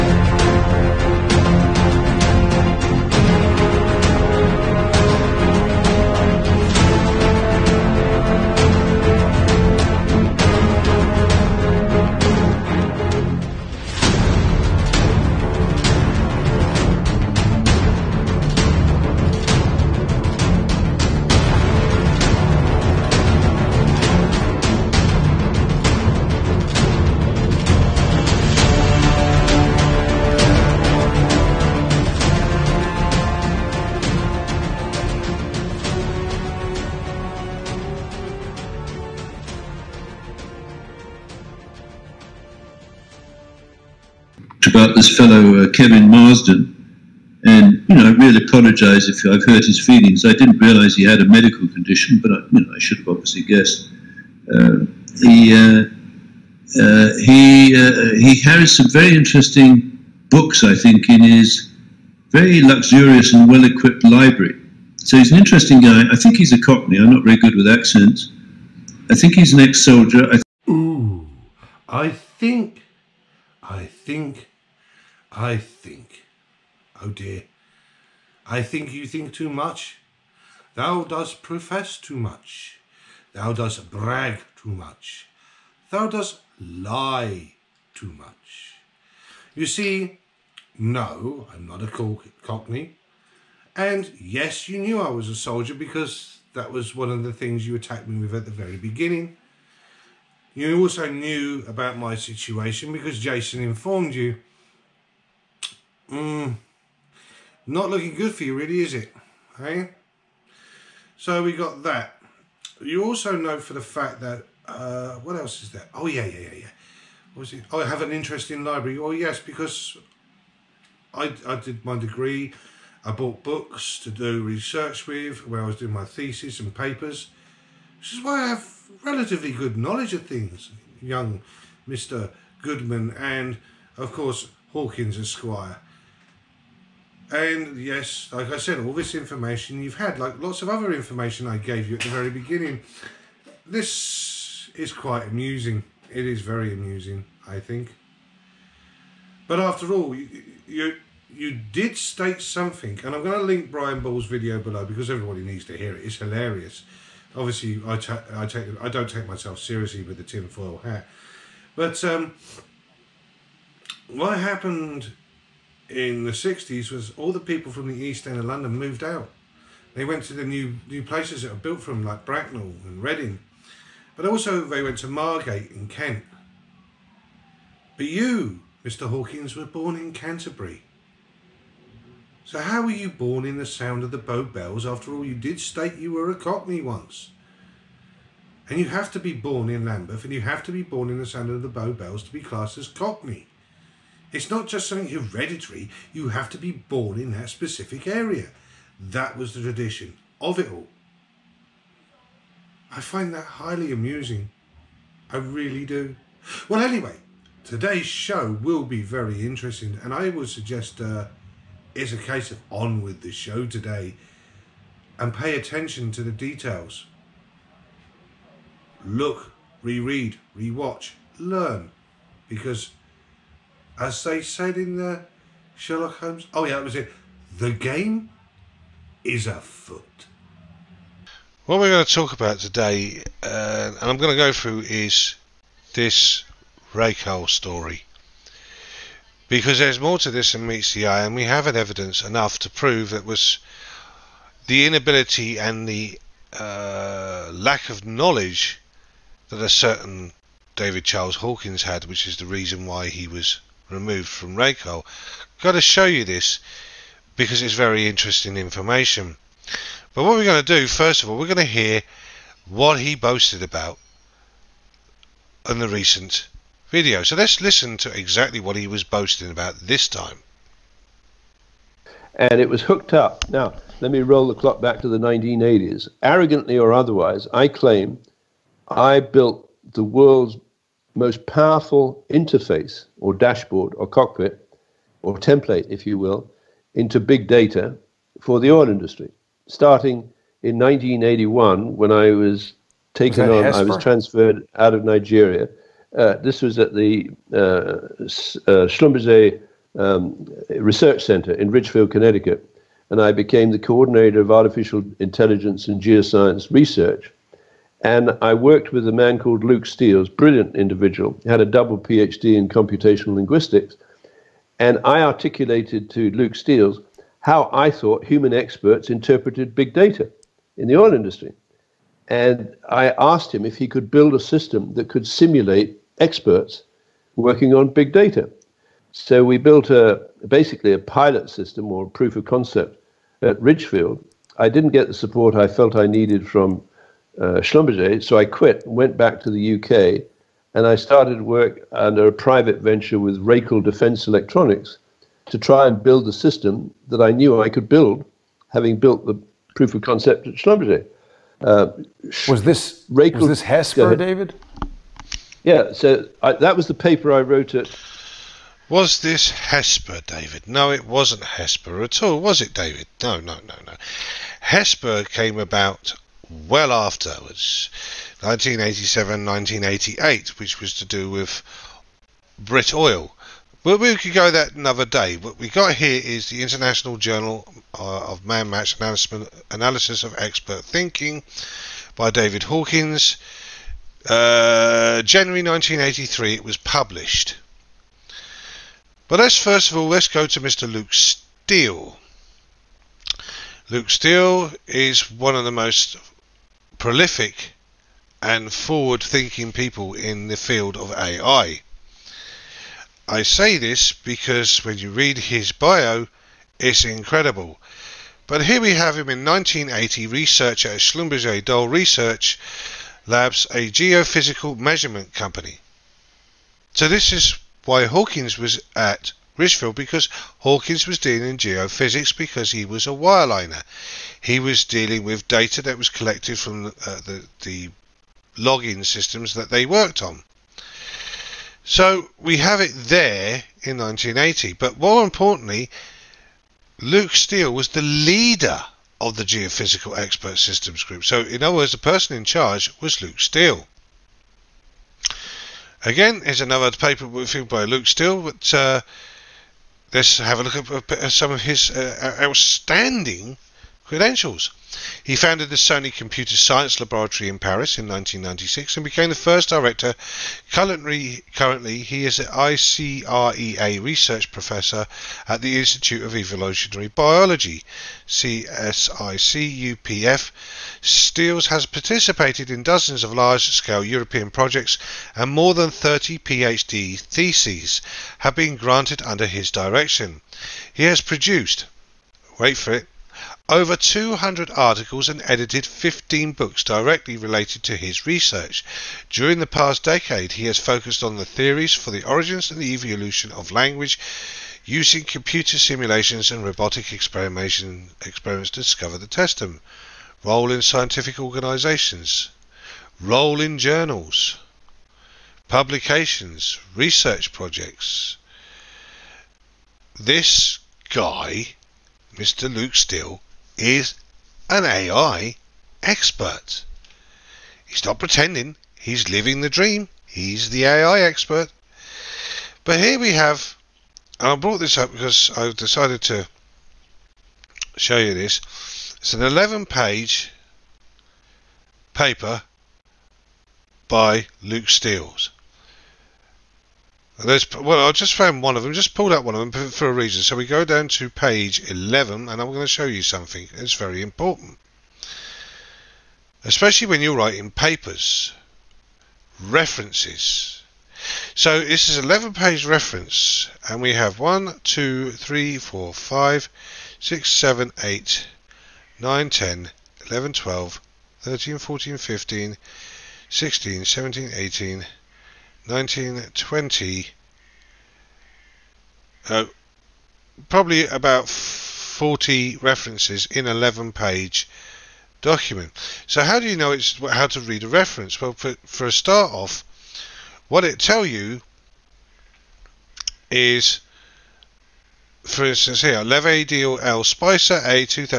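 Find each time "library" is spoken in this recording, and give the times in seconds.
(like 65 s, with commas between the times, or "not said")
64 s, 118 s.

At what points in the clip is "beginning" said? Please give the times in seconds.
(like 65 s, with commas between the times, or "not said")
98 s, 142 s.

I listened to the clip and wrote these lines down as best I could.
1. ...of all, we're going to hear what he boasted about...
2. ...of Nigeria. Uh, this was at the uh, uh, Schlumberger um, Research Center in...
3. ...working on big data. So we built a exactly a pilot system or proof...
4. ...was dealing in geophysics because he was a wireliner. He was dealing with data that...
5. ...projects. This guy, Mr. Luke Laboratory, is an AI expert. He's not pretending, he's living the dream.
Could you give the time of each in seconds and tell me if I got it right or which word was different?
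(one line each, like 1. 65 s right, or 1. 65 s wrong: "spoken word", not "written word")
1. 261 s right
2. 294 s right
3. 327 s wrong: "basically", not "exactly"
4. 421 s right
5. 507 s wrong: "Steele", not "Laboratory".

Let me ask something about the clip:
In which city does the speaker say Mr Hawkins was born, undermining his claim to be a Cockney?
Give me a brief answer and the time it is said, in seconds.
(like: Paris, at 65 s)
Canterbury, at 180 s.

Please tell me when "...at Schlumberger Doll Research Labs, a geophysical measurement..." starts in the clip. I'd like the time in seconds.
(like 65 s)
410 s.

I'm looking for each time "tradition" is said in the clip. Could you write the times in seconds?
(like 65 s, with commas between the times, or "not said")
199 s.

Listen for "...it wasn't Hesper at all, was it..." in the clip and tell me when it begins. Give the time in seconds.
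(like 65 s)
360 s.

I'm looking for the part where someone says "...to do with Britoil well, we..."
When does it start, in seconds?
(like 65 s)
370 s.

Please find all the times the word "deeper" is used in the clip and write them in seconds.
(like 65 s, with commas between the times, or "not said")
not said.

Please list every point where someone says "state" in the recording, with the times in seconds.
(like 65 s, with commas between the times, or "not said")
151 s, 185 s.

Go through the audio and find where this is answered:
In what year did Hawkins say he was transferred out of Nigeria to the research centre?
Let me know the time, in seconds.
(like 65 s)
290 s.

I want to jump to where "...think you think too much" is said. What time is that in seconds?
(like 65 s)
78 s.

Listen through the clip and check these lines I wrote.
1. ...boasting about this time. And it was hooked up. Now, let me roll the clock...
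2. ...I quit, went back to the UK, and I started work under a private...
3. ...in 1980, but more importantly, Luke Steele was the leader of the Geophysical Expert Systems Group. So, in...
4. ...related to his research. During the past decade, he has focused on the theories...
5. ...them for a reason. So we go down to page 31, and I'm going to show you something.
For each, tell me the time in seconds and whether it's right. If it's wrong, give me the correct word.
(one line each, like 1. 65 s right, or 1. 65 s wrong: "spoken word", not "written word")
1. 269 s right
2. 338 s right
3. 433 s right
4. 487 s right
5. 539 s wrong: "11", not "31".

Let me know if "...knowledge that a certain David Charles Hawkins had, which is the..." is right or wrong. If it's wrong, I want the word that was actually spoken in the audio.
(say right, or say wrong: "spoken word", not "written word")
right.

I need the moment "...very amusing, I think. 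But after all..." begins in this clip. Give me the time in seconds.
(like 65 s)
146 s.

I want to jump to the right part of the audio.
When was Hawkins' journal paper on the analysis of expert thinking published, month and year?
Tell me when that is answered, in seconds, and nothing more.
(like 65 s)
385 s.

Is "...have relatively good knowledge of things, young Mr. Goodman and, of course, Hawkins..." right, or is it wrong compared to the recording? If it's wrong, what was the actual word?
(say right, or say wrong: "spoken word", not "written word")
right.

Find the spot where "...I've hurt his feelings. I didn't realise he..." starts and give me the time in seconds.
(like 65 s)
49 s.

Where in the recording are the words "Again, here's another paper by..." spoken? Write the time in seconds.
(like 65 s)
446 s.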